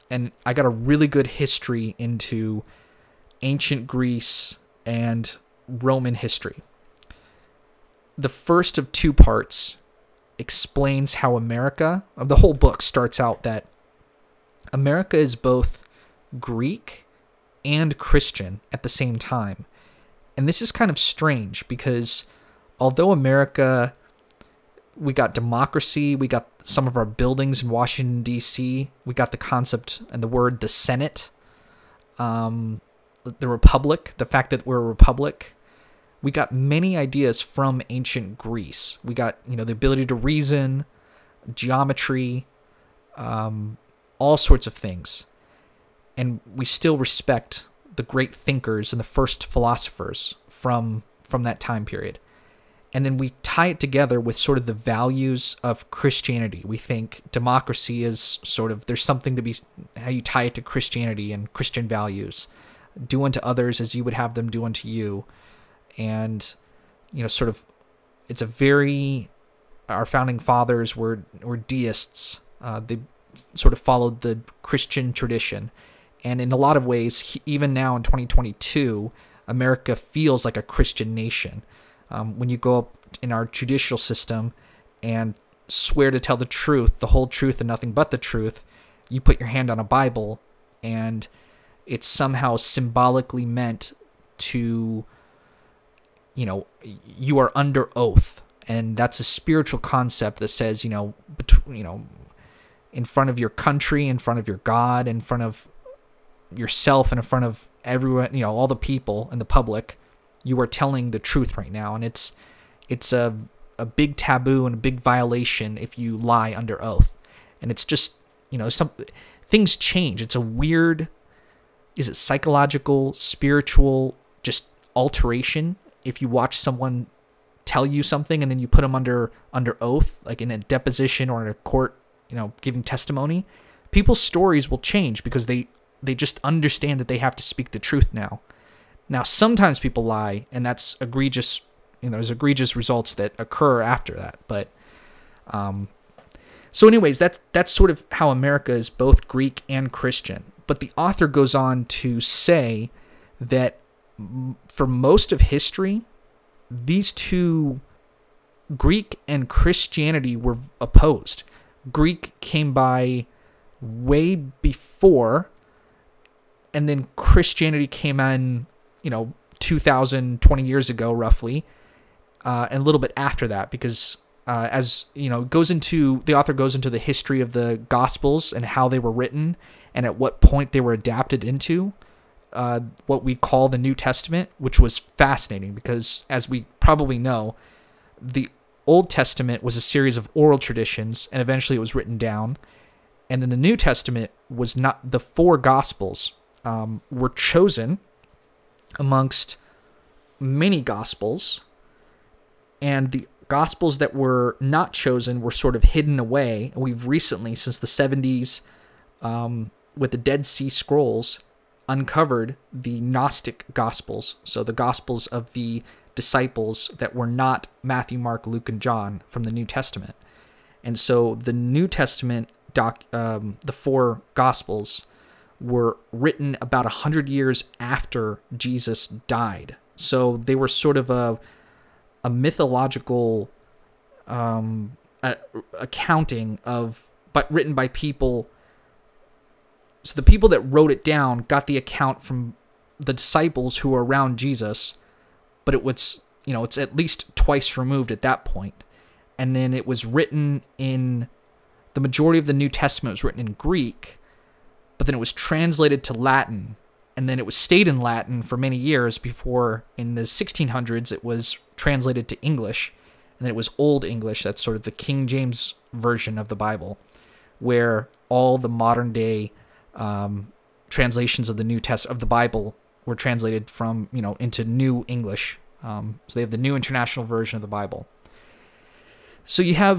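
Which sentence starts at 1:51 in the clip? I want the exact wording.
And it's, it's a, a big taboo and a big violation if you lie under oath.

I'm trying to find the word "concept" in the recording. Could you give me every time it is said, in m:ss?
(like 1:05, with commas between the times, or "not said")
0:29, 1:39.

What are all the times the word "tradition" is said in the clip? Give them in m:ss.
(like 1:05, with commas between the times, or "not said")
1:15, 3:10.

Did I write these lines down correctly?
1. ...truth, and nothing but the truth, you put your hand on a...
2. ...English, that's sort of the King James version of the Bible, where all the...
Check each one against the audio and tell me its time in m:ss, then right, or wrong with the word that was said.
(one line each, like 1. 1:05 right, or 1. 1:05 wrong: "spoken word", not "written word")
1. 1:27 right
2. 4:24 right.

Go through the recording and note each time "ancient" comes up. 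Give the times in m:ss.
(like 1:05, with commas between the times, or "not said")
0:03, 0:37.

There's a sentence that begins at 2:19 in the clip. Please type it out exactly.
Now, sometimes people lie, and that's egregious.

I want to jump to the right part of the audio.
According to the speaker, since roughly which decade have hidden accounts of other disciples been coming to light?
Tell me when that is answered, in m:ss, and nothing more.
3:27.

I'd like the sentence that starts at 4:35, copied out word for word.
Um, so they have the New International Version of the Bible.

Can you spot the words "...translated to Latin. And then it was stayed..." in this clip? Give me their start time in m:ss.
4:15.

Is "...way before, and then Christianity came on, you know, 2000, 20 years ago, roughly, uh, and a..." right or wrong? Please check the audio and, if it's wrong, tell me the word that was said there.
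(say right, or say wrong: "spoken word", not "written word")
right.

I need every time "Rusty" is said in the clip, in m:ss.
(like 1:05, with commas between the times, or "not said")
not said.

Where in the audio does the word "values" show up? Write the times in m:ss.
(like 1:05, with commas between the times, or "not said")
0:54, 1:01.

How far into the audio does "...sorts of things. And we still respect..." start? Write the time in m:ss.
0:44.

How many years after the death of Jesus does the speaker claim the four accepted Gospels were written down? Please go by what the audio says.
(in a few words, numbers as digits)
100 years.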